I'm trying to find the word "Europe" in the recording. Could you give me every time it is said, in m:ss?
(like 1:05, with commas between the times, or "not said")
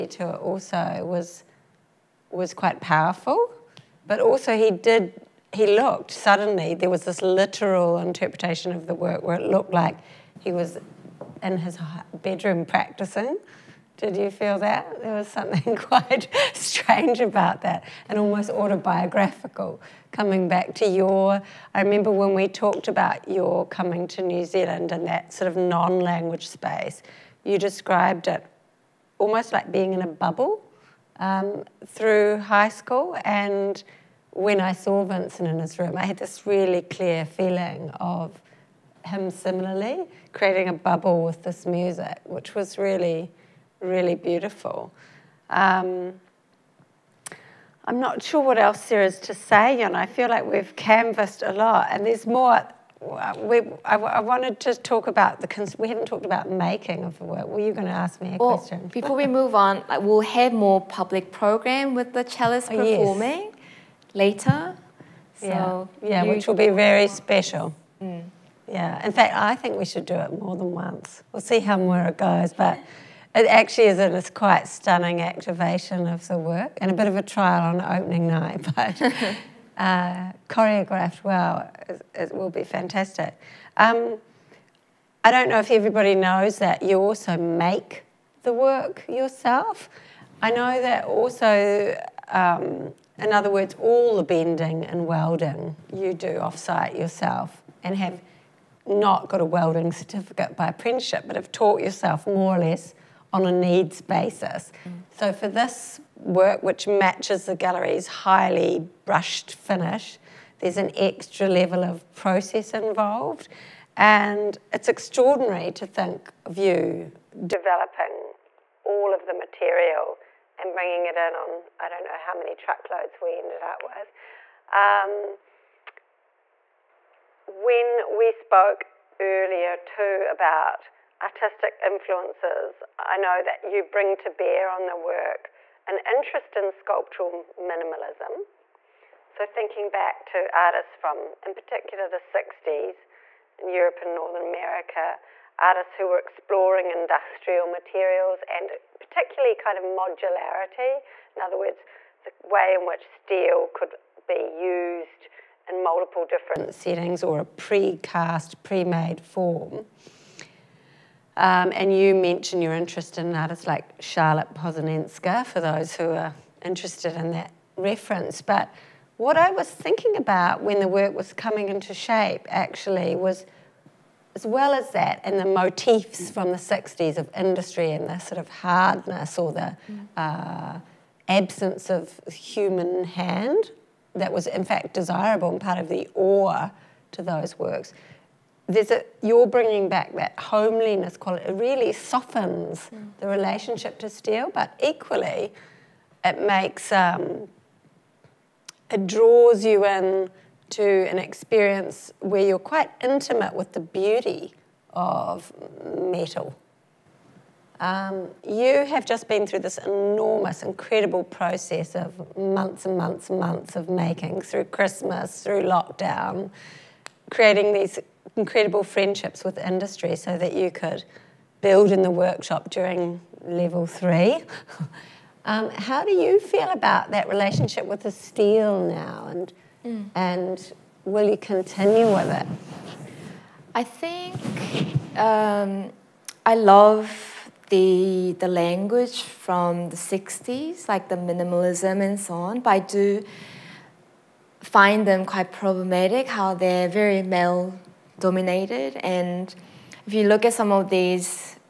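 2:23.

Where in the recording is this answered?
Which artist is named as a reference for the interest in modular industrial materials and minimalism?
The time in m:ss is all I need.
2:44.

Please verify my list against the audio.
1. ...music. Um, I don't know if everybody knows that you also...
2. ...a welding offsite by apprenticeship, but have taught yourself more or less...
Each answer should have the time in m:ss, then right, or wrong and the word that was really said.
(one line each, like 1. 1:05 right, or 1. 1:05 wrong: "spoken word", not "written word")
1. 1:22 wrong: "fantastic", not "music"
2. 1:39 wrong: "certificate", not "offsite".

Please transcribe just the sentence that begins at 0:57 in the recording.
Were you going to ask me a well, question?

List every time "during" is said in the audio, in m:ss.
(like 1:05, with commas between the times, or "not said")
3:42.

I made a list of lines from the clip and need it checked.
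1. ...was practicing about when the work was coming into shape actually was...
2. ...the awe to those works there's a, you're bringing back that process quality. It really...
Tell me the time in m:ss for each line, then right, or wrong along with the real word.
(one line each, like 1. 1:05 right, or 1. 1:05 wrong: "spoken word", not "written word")
1. 2:49 wrong: "thinking", not "practicing"
2. 3:05 wrong: "homeliness", not "process".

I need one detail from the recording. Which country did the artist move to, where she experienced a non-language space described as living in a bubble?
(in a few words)
New Zealand.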